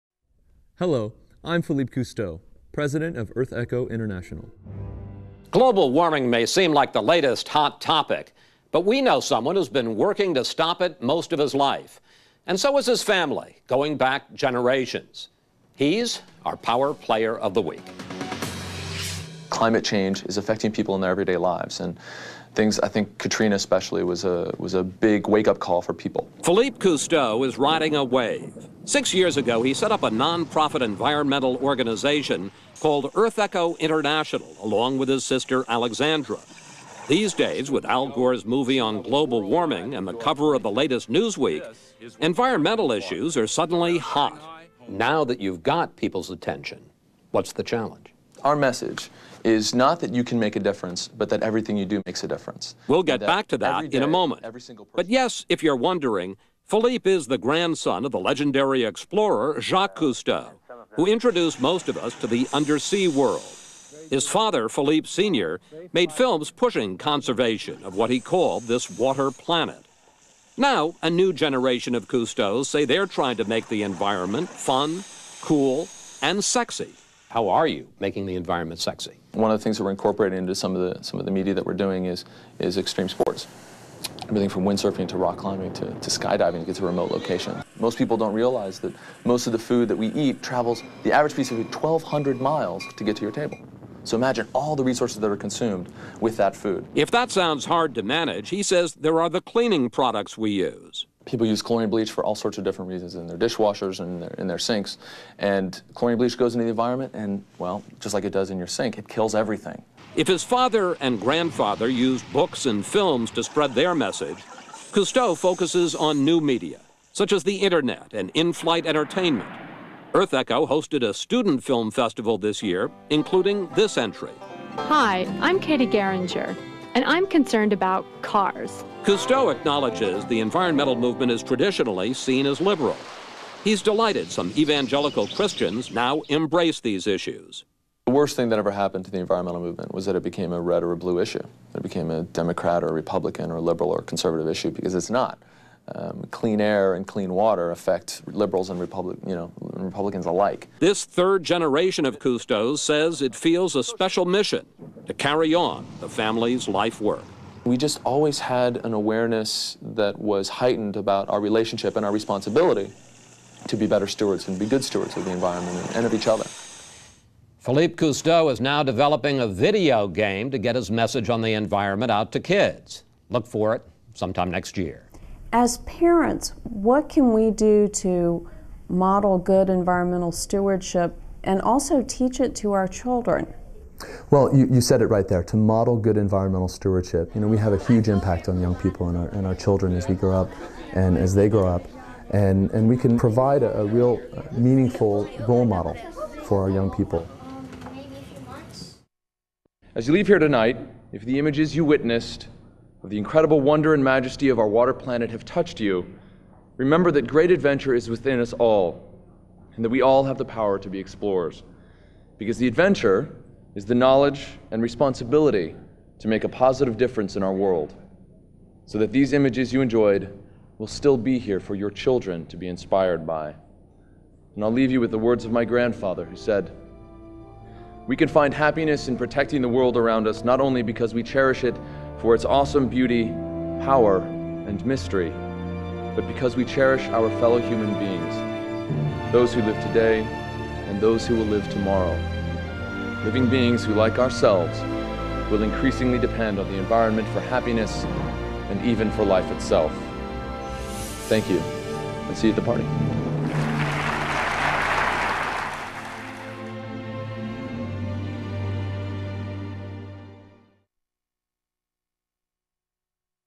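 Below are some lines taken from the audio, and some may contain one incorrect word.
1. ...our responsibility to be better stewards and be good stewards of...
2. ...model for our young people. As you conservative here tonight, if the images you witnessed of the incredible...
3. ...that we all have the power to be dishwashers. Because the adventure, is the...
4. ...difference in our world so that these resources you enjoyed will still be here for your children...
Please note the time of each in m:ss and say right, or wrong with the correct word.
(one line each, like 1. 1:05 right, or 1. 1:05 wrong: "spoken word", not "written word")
1. 2:42 right
2. 3:15 wrong: "leave", not "conservative"
3. 3:29 wrong: "explorers", not "dishwashers"
4. 3:36 wrong: "images", not "resources".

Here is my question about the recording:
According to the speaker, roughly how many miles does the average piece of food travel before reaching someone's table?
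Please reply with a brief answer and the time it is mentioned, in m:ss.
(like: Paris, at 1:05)
1,200 miles, at 1:31.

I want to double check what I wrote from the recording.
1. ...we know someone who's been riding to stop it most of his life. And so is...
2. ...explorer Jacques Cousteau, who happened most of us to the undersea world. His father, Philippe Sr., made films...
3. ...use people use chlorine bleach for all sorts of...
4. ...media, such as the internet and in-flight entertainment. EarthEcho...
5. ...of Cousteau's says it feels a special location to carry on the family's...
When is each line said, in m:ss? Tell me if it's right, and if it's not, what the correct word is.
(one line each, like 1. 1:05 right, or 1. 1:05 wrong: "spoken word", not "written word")
1. 0:08 wrong: "working", not "riding"
2. 0:58 wrong: "introduced", not "happened"
3. 1:40 right
4. 1:56 right
5. 2:32 wrong: "mission", not "location".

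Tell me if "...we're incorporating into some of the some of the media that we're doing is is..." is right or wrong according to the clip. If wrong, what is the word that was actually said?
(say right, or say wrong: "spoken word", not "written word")
right.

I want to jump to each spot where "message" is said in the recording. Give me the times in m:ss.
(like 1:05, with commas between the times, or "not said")
0:48, 1:53, 2:50.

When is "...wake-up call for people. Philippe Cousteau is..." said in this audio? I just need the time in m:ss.
0:25.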